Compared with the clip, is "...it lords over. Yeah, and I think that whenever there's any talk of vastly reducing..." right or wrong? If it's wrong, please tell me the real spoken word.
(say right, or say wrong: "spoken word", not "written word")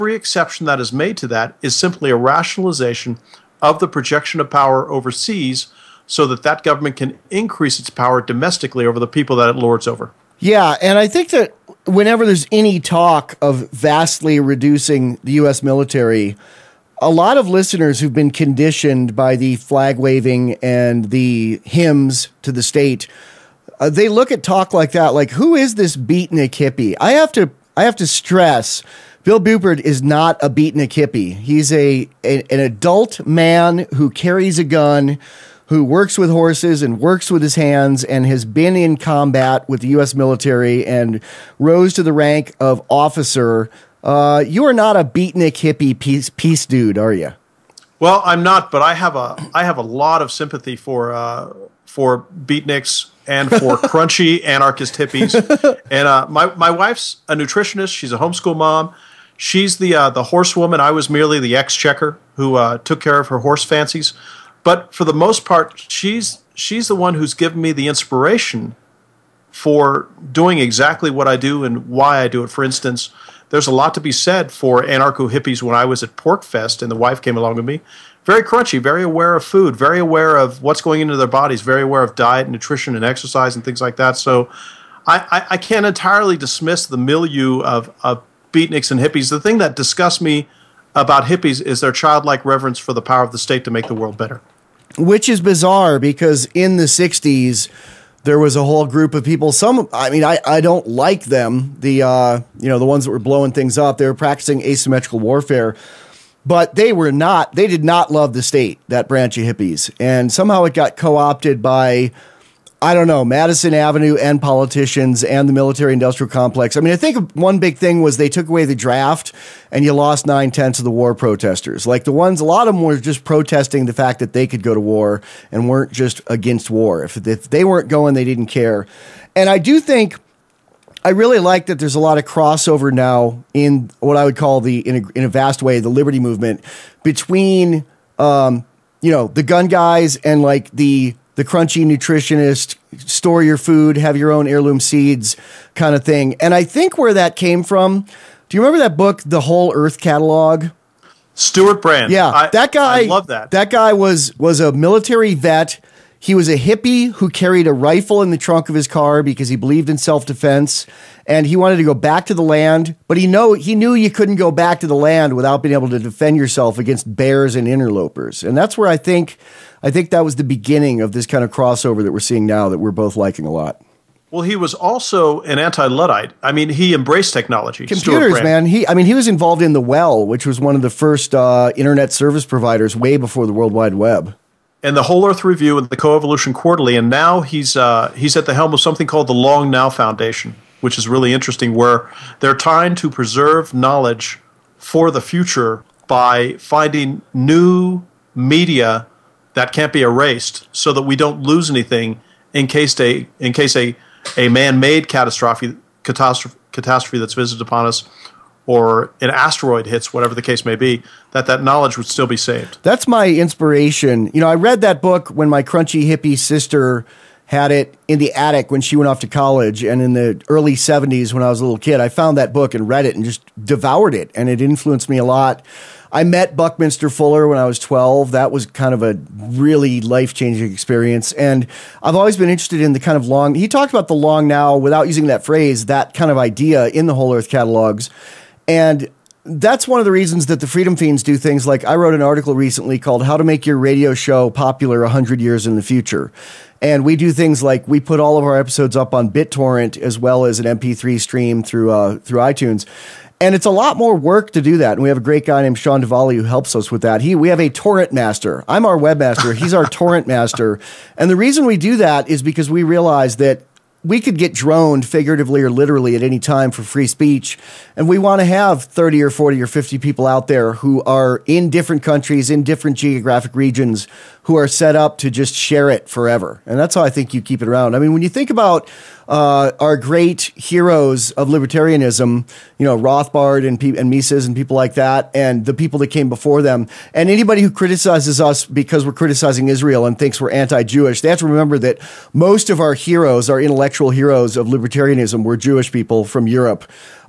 right.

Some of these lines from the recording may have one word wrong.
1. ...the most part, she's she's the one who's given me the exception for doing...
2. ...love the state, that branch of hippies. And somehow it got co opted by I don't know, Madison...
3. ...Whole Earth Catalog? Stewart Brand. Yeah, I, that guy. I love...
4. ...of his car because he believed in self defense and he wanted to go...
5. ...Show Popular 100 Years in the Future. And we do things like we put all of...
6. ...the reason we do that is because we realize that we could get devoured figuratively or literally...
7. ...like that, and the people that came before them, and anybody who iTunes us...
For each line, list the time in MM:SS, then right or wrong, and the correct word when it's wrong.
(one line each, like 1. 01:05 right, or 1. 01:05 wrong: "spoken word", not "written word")
1. 01:05 wrong: "inspiration", not "exception"
2. 01:48 right
3. 02:29 right
4. 02:38 right
5. 04:04 right
6. 04:21 wrong: "droned", not "devoured"
7. 04:44 wrong: "criticizes", not "iTunes".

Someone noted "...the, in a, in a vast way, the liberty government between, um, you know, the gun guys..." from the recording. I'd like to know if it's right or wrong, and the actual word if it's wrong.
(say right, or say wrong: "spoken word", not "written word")
wrong: "movement", not "government".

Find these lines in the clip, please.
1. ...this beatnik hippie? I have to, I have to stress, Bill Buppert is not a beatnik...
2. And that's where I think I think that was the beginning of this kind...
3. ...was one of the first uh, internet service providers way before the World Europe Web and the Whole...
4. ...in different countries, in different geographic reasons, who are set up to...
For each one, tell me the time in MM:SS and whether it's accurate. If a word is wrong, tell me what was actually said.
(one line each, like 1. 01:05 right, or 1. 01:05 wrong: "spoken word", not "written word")
1. 00:25 right
2. 02:48 right
3. 03:00 wrong: "Wide", not "Europe"
4. 04:31 wrong: "regions", not "reasons".